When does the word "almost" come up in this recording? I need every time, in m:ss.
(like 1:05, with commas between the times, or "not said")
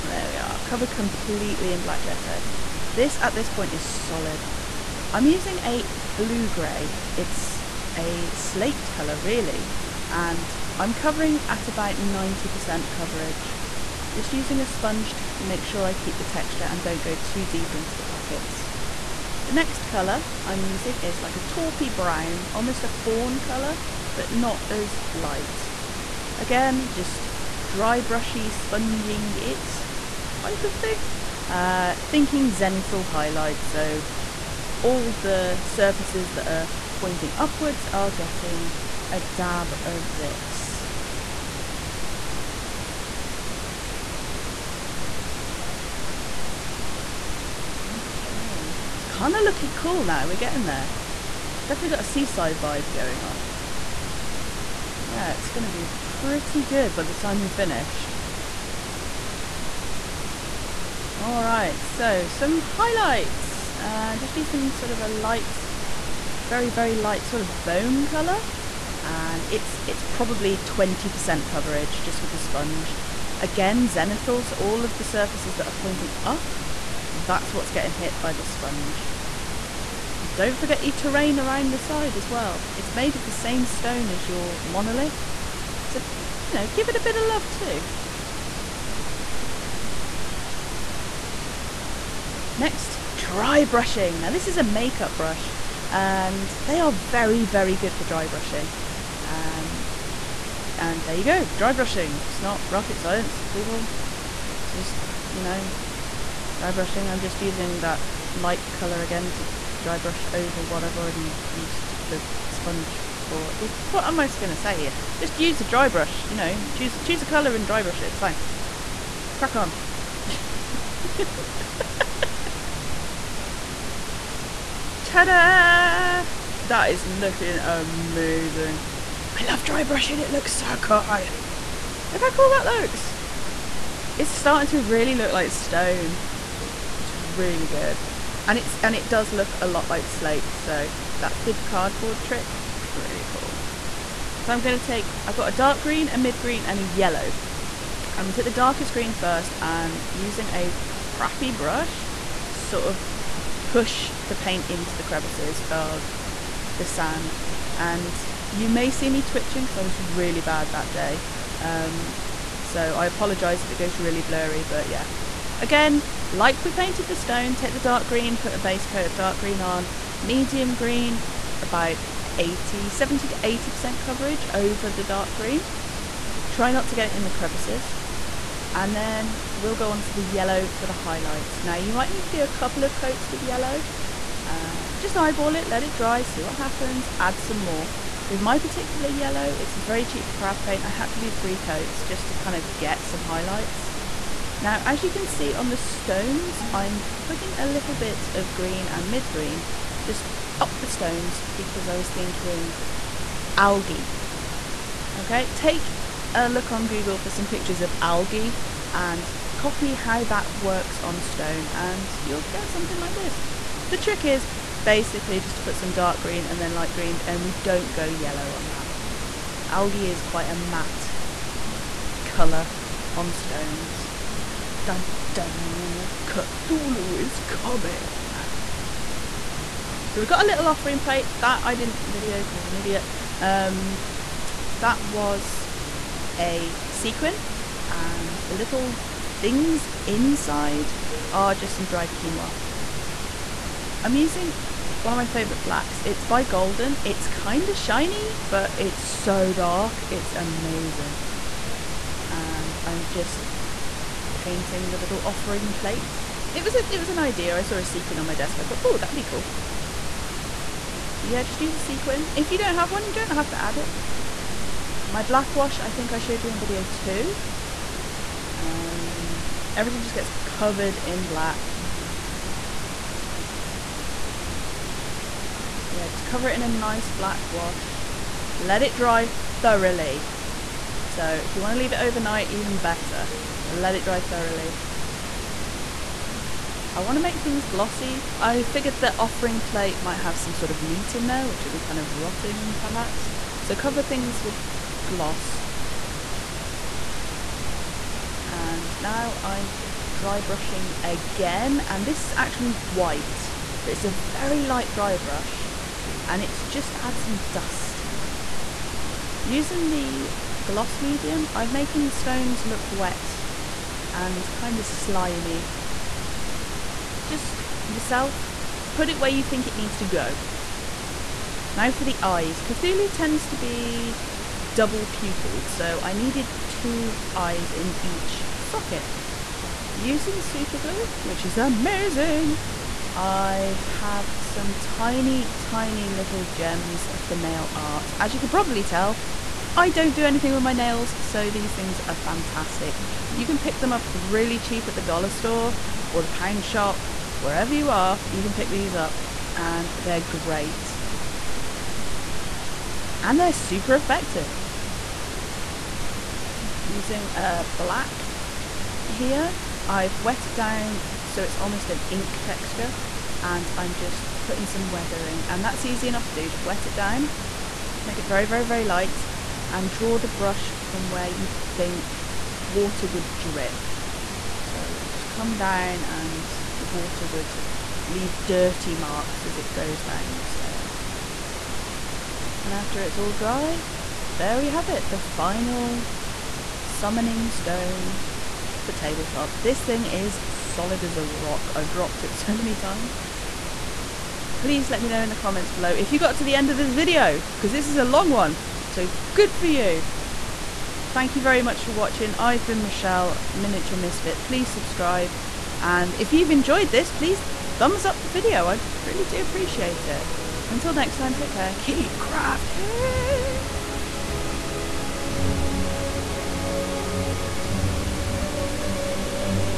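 0:22, 6:01.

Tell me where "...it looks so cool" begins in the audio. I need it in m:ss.
2:10.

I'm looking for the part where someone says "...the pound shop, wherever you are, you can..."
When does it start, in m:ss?
5:46.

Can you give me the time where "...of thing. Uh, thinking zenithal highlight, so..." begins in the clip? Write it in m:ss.
0:30.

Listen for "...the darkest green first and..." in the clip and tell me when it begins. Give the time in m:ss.
2:28.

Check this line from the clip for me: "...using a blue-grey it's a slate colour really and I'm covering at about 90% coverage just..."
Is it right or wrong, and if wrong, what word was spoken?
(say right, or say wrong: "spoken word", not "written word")
right.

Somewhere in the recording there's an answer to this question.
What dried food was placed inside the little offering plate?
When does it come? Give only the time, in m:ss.
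4:02.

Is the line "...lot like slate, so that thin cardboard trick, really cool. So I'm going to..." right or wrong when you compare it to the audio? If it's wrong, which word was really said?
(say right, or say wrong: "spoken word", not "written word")
right.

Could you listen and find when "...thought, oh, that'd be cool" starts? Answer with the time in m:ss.
4:18.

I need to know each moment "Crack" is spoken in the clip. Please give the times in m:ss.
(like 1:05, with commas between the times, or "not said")
1:59.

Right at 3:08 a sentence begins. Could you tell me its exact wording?
With my particular yellow, it's a very cheap craft paint.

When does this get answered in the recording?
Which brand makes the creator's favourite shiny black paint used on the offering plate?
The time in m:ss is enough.
4:06.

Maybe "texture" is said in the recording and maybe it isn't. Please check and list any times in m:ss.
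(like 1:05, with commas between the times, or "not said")
0:16, 6:02.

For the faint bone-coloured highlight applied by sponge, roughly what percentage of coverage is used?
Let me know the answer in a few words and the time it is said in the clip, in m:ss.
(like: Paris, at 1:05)
20%, at 1:10.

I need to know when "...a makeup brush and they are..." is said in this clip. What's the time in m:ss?
1:34.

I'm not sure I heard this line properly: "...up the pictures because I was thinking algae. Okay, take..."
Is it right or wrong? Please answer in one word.
wrong.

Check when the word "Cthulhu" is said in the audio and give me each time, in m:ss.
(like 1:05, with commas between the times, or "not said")
3:46, 5:22.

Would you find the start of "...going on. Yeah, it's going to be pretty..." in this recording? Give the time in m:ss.
0:52.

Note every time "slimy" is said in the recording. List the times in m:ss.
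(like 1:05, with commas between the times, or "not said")
5:14.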